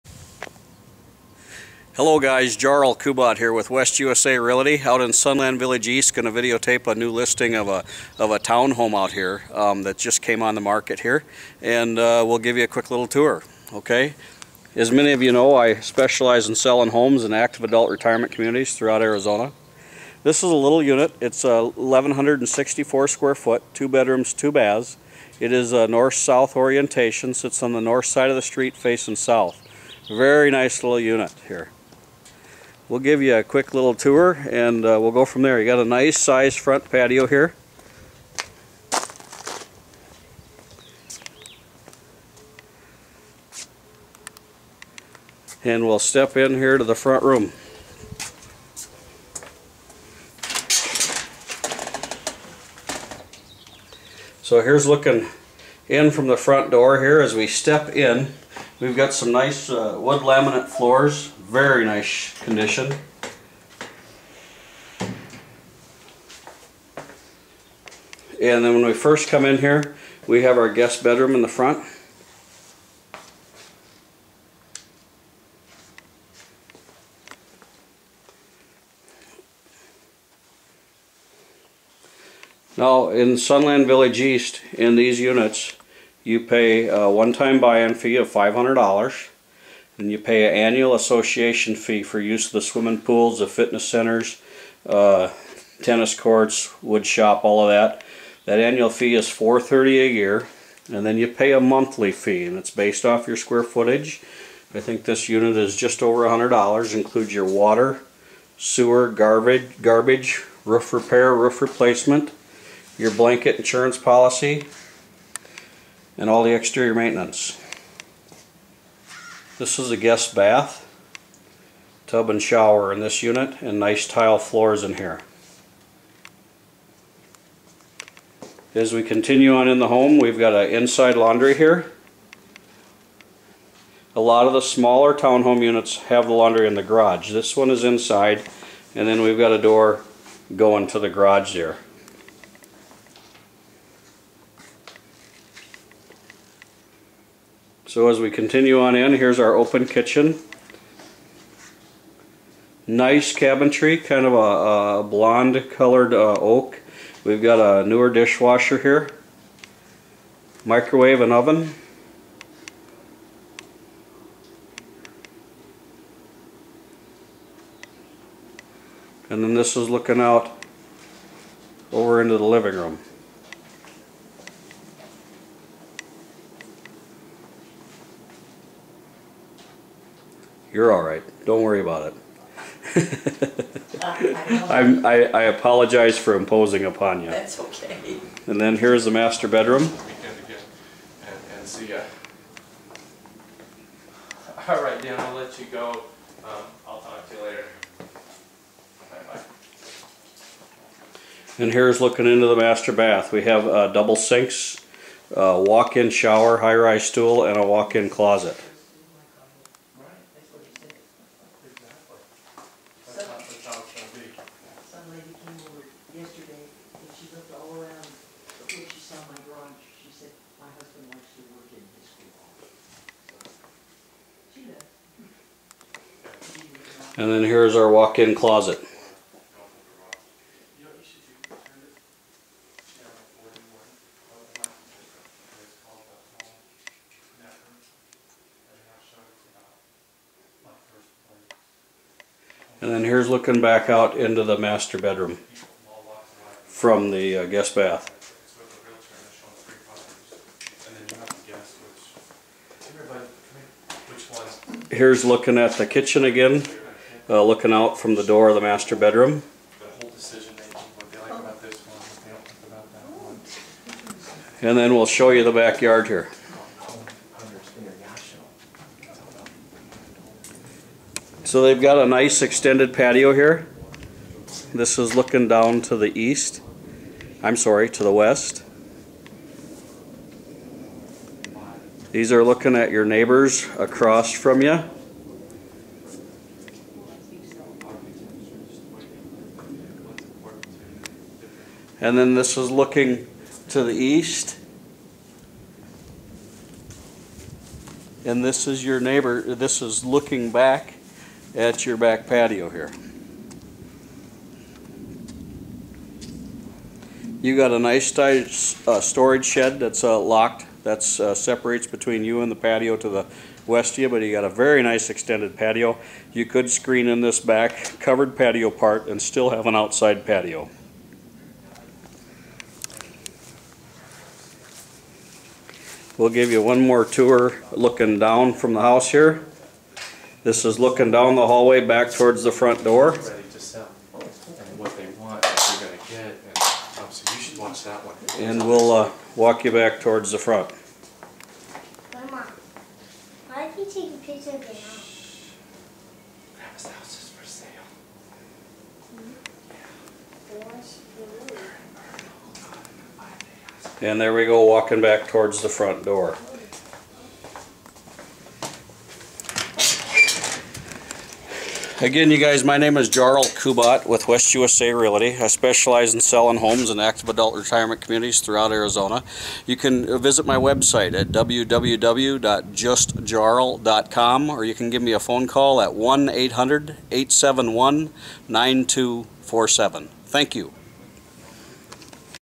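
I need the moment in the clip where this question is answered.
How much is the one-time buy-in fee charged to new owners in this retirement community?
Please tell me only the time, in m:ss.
1:28.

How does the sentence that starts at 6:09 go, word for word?
You can visit my website at www.justjarl.com or you can give me a phone call at 1 800 871 9247.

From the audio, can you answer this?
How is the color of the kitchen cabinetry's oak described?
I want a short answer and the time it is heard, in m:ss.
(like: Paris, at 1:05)
blonde, at 2:35.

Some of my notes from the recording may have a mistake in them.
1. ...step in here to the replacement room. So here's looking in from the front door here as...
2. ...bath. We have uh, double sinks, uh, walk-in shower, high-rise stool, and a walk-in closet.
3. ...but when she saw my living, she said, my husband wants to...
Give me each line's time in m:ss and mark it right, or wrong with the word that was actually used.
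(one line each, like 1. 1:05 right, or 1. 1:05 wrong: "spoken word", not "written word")
1. 0:45 wrong: "front", not "replacement"
2. 3:22 right
3. 3:38 wrong: "drawing", not "living".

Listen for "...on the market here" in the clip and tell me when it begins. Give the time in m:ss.
0:10.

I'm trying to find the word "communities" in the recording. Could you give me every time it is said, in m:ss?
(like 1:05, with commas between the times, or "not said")
0:18, 6:08.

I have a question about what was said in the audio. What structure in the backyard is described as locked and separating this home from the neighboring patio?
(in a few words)
storage shed.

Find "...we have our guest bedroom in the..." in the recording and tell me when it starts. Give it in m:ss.
1:10.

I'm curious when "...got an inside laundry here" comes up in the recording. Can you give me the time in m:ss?
2:10.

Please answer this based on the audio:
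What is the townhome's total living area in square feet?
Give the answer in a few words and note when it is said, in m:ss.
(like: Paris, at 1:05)
1,164, at 0:21.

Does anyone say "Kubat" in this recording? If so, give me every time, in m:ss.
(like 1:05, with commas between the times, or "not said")
0:02, 6:03.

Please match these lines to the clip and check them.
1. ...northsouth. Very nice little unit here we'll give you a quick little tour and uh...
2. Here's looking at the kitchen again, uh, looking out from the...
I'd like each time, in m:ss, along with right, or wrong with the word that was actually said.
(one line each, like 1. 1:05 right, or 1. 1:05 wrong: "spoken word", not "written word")
1. 0:29 wrong: "south", not "northsouth"
2. 4:14 right.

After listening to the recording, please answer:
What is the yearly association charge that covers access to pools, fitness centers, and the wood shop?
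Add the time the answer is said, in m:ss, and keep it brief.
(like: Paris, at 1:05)
$430, at 1:39.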